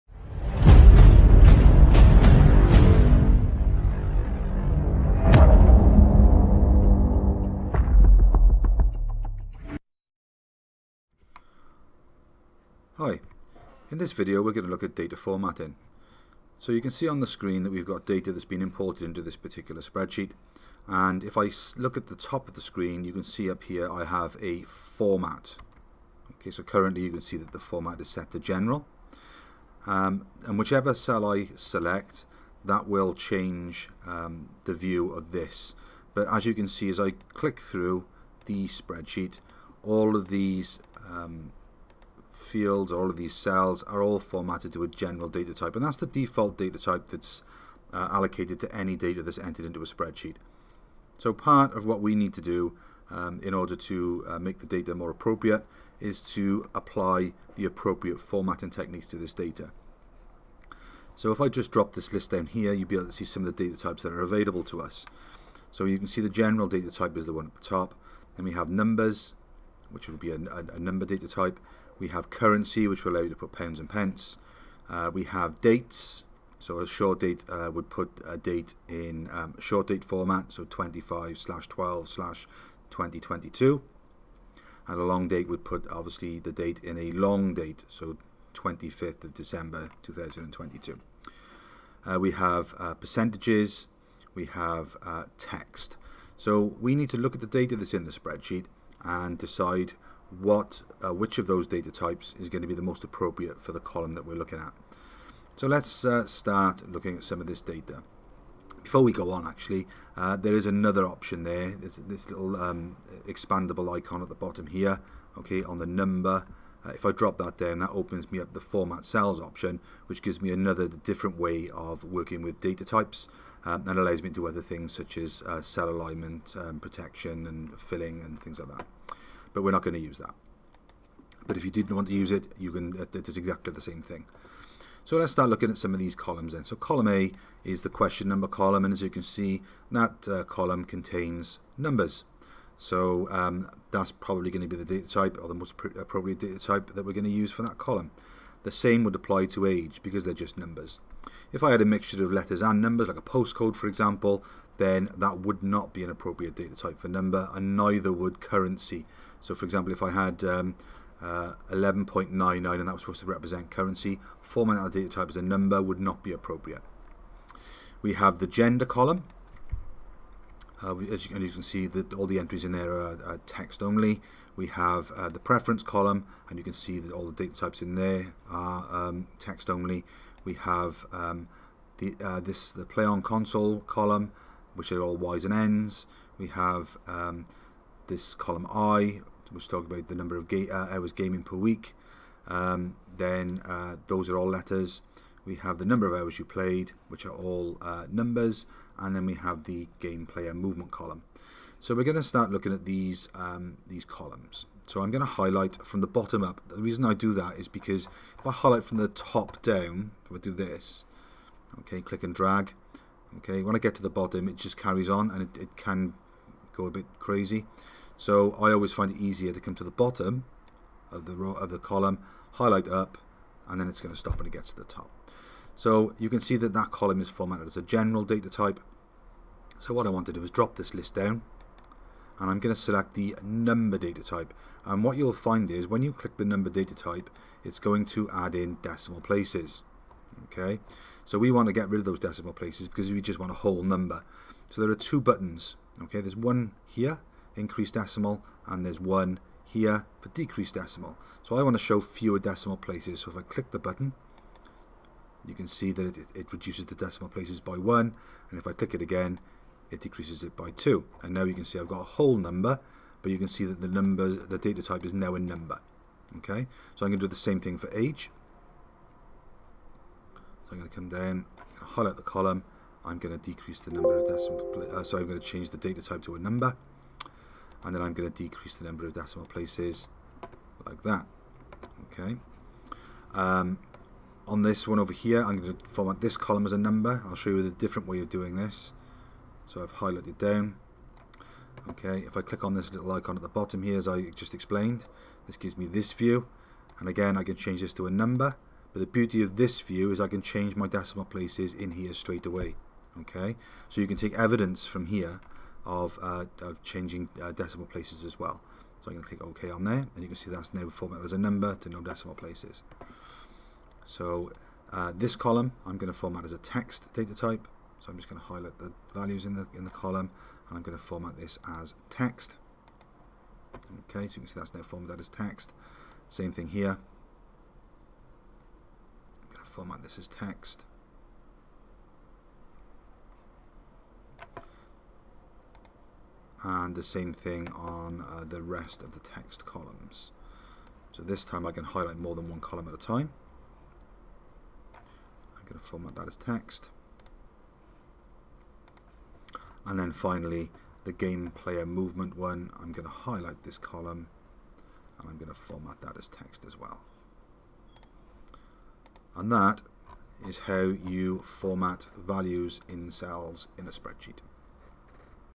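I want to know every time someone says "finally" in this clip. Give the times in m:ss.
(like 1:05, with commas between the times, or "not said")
5:50.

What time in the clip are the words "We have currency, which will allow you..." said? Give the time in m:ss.
1:12.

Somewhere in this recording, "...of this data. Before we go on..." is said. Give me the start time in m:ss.
1:47.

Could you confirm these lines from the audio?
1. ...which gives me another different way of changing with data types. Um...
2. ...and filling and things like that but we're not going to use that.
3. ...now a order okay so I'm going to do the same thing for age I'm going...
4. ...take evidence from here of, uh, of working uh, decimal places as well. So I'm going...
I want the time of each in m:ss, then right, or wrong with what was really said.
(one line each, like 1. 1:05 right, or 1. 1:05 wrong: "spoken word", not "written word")
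1. 2:00 wrong: "working", not "changing"
2. 2:07 right
3. 4:25 wrong: "number", not "order"
4. 5:04 wrong: "changing", not "working".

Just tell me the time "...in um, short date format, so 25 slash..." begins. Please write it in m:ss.
1:18.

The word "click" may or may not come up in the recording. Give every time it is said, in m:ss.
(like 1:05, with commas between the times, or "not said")
0:37, 3:32, 3:56, 4:13, 4:18, 4:52, 5:09.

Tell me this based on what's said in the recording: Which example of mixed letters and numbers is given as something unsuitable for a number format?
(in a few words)
a postcode.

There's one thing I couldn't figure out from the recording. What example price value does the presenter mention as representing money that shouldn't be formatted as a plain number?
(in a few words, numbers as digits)
11.99.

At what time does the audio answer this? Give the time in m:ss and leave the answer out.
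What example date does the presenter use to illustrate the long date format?
1:28.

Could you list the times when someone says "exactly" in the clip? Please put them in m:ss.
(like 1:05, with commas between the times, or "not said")
2:13.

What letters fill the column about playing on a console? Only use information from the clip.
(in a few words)
y's and n's.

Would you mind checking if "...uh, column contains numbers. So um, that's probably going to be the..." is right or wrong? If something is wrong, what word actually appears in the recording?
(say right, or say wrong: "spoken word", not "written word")
right.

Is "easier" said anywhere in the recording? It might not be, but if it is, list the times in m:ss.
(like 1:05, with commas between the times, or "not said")
3:39.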